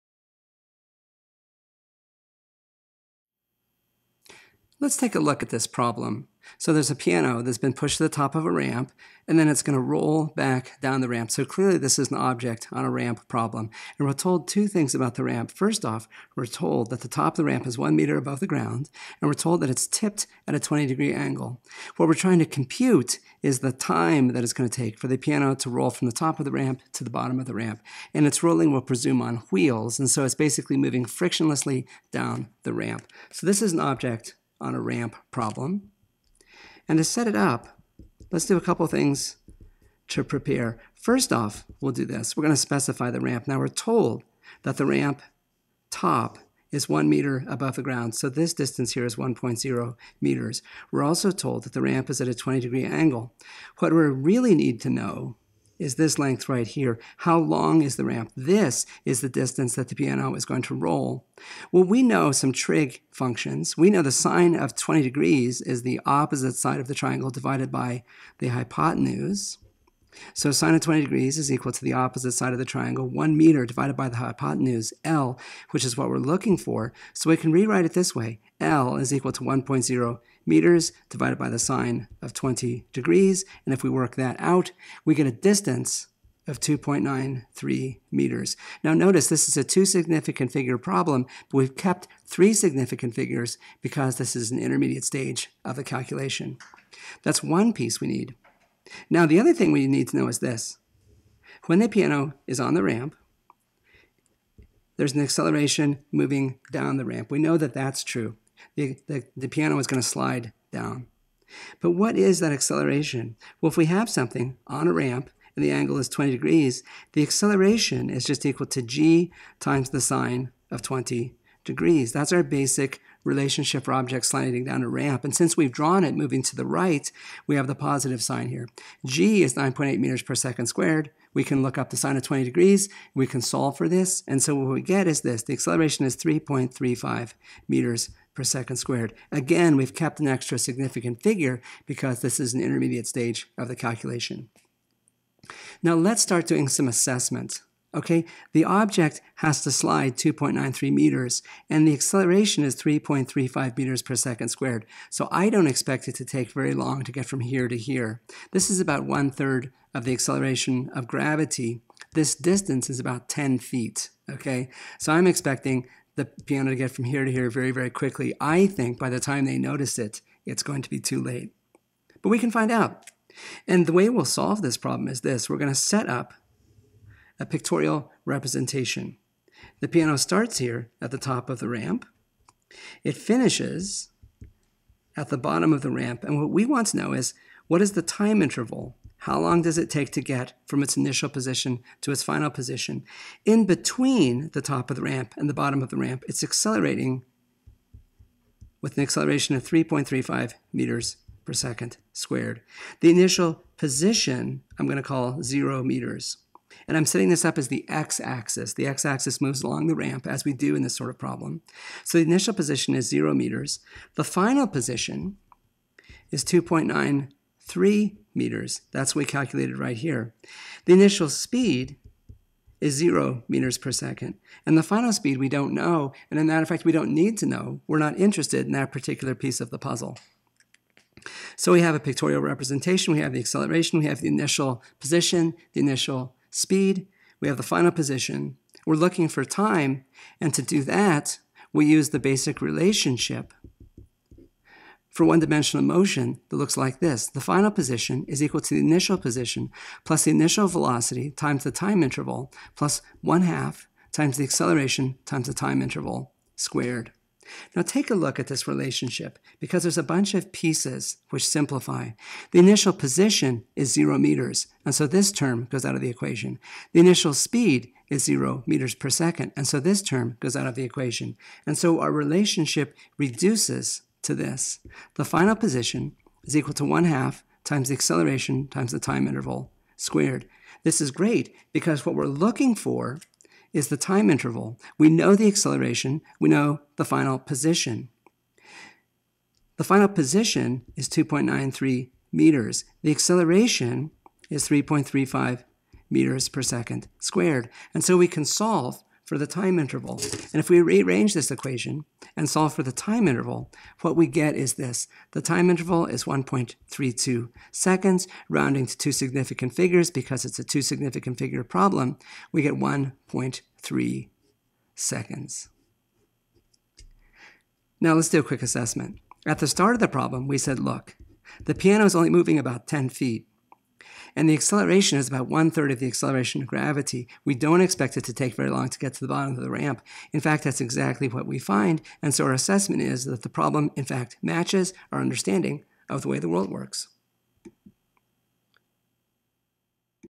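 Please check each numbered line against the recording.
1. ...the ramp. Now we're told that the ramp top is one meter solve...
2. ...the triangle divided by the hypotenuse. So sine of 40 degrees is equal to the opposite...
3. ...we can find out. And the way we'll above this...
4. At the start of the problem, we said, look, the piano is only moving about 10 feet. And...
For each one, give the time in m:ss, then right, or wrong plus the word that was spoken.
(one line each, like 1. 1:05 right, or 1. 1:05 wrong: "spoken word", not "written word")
1. 0:43 wrong: "above", not "solve"
2. 1:06 wrong: "20", not "40"
3. 2:52 wrong: "solve", not "above"
4. 5:19 right.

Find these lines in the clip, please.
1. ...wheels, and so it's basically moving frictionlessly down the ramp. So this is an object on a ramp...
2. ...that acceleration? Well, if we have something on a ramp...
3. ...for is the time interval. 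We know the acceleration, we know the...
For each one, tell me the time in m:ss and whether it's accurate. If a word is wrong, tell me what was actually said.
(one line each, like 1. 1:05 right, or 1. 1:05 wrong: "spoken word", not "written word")
1. 0:29 right
2. 1:52 right
3. 4:42 right.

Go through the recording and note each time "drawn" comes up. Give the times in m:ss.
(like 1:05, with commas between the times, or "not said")
2:05.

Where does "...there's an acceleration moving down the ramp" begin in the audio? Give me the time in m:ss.
1:44.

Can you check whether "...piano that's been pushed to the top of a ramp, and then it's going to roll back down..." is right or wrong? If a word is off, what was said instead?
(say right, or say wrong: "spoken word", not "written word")
right.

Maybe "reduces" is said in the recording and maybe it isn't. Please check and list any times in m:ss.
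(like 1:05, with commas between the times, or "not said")
4:33.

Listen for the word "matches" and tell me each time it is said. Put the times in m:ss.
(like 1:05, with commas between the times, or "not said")
5:34.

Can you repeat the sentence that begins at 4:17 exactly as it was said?
Now take a look at this relationship because there's a bunch of pieces which simplify.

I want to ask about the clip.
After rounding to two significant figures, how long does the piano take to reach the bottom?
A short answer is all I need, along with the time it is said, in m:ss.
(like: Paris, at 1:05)
1.3 seconds, at 5:12.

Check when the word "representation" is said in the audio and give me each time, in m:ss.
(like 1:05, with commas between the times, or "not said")
2:58, 3:52.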